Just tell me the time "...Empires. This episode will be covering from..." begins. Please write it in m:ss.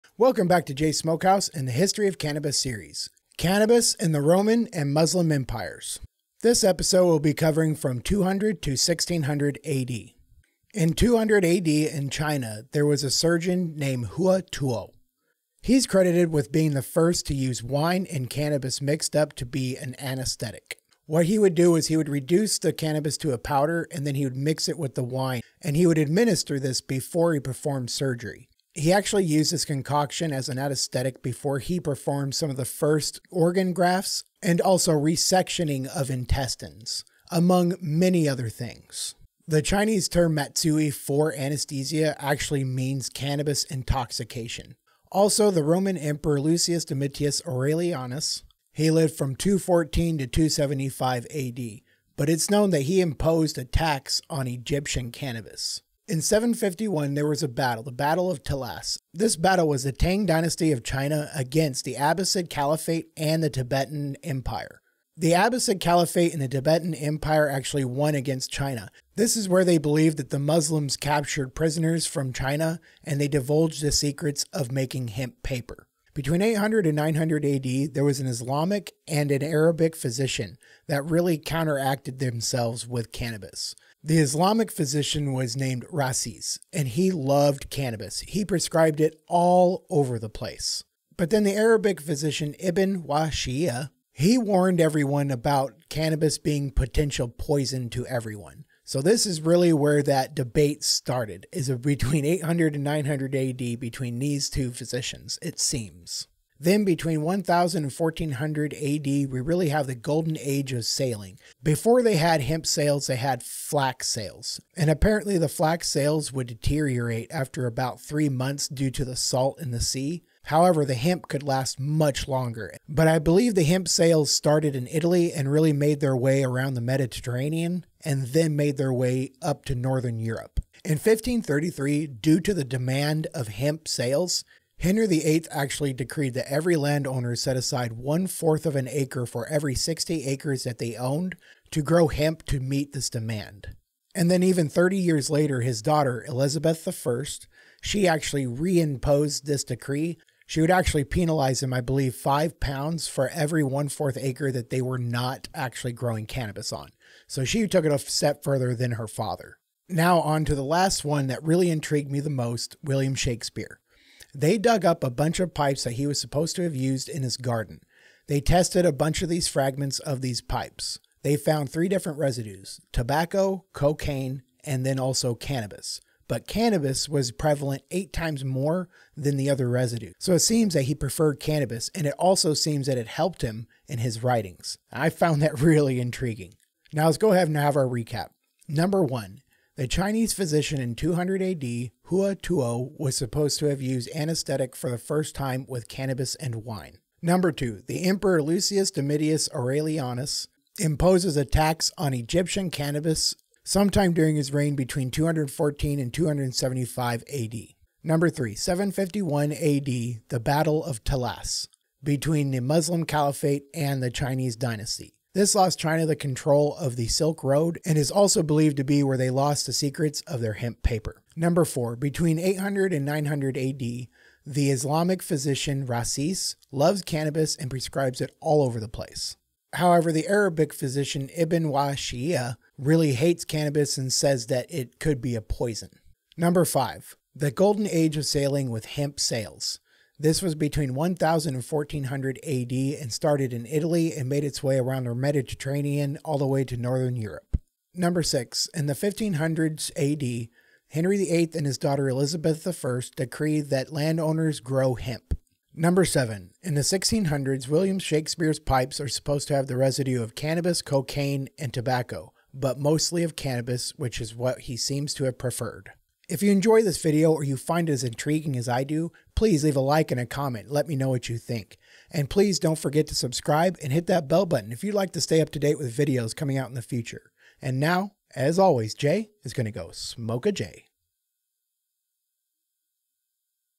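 0:05.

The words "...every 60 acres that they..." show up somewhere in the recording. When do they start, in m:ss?
2:19.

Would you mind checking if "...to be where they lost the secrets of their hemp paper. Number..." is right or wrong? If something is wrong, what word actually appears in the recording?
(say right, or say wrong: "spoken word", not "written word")
right.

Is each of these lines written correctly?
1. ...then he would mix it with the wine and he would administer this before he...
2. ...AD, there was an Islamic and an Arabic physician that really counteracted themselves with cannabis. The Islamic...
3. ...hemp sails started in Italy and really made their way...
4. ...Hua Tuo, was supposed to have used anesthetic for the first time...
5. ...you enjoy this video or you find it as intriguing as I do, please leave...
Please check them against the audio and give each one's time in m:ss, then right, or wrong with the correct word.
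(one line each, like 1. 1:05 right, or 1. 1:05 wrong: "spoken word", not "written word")
1. 0:24 right
2. 1:17 right
3. 2:03 right
4. 3:12 right
5. 4:26 right.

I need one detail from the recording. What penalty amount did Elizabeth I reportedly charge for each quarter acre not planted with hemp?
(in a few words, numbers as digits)
5 pounds.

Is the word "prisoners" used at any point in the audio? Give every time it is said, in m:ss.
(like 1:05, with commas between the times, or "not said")
1:11.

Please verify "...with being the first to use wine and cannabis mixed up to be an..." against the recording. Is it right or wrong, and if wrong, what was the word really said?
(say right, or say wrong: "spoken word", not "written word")
right.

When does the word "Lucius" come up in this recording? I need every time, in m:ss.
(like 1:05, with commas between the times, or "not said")
0:46, 3:18.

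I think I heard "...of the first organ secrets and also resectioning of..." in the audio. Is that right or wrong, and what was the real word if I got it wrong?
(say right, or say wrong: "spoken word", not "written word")
wrong: "grafts", not "secrets".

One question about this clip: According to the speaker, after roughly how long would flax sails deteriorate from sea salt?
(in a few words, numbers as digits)
3 months.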